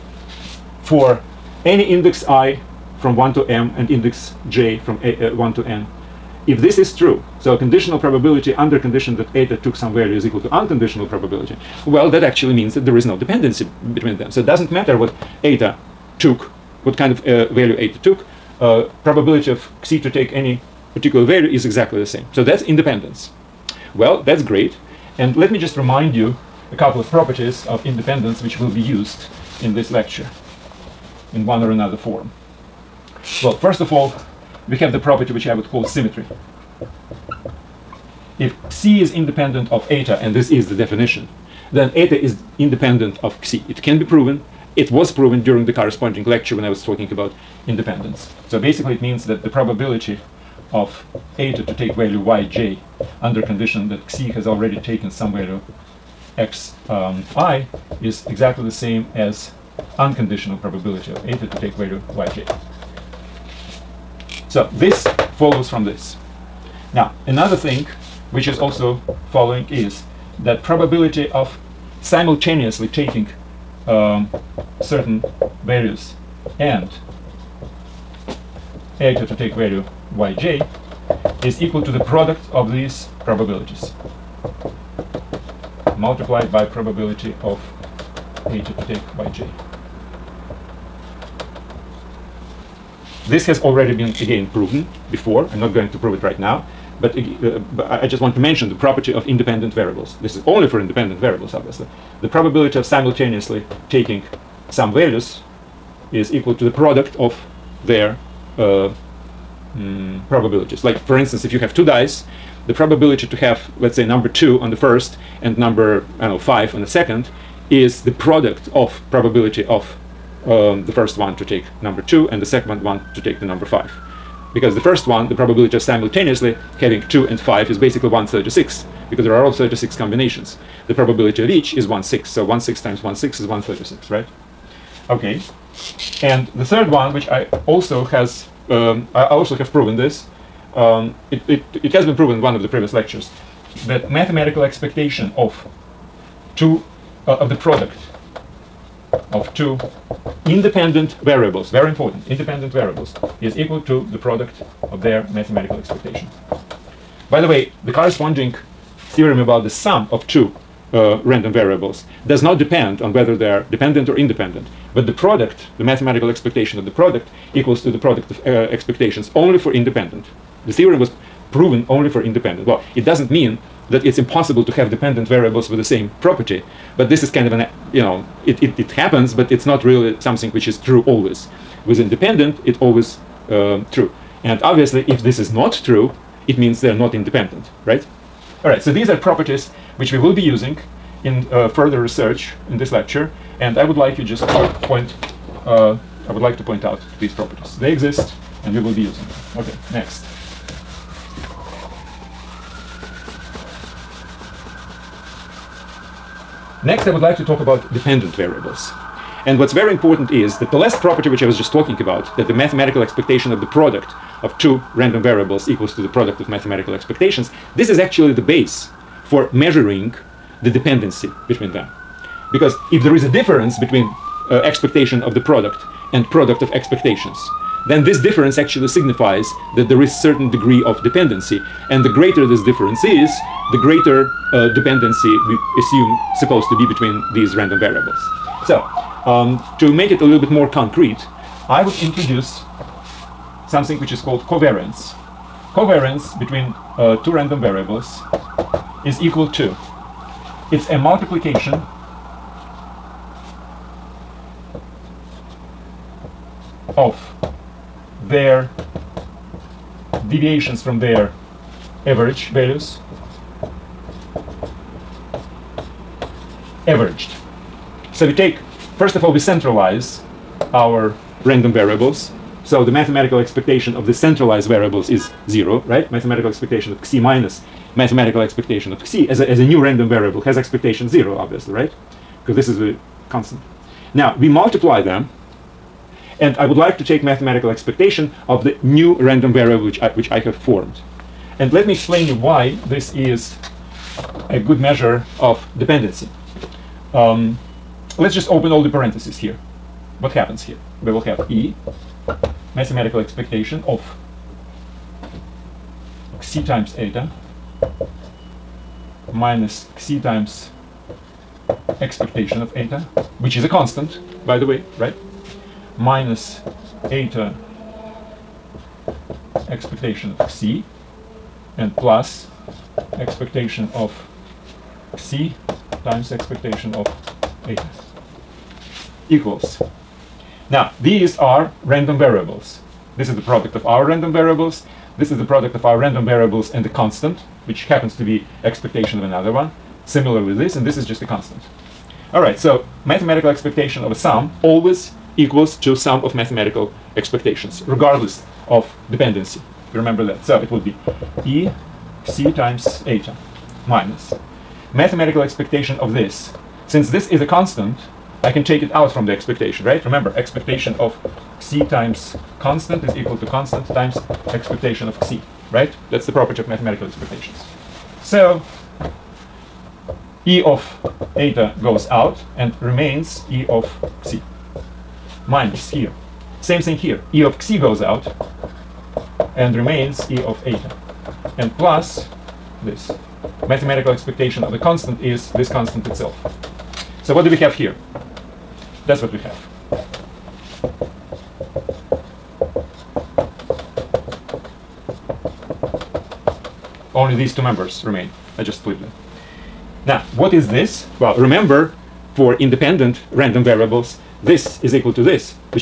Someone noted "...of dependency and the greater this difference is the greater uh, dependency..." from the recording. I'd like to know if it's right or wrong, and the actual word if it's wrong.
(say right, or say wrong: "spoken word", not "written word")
right.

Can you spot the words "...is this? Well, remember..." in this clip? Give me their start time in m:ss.
6:40.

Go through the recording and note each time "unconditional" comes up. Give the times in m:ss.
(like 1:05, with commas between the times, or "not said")
0:10, 0:59.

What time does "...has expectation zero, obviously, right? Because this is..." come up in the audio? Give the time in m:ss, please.
4:40.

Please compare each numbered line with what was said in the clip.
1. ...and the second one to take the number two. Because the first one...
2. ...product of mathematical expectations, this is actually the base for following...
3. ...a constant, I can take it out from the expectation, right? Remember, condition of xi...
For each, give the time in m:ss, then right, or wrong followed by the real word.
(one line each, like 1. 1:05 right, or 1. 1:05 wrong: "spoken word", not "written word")
1. 2:02 wrong: "five", not "two"
2. 3:36 wrong: "measuring", not "following"
3. 5:57 wrong: "expectation", not "condition".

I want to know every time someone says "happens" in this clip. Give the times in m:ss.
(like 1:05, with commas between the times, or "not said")
2:58, 5:00, 5:37.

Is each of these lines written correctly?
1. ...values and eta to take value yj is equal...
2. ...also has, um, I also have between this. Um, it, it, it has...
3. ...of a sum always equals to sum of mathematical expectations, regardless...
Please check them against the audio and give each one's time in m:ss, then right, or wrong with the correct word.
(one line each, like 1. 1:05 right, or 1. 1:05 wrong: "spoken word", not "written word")
1. 1:15 right
2. 2:17 wrong: "proven", not "between"
3. 5:44 right.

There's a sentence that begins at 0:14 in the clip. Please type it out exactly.
So it doesn't matter what eta took, what kind of uh, value eta took.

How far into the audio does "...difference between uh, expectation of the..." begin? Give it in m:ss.
3:43.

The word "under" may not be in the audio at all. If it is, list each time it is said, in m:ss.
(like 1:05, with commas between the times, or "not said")
0:08, 0:53.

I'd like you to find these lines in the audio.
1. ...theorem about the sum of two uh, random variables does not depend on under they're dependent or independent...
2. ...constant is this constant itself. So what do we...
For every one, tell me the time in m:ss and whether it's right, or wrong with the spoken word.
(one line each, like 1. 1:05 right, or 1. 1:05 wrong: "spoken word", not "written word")
1. 2:39 wrong: "whether", not "under"
2. 6:24 right.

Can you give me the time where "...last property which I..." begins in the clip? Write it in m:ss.
3:30.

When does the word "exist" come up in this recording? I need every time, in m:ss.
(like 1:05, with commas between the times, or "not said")
3:17.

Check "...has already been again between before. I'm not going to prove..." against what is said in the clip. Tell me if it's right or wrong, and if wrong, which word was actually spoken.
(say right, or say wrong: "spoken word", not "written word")
wrong: "proven", not "between".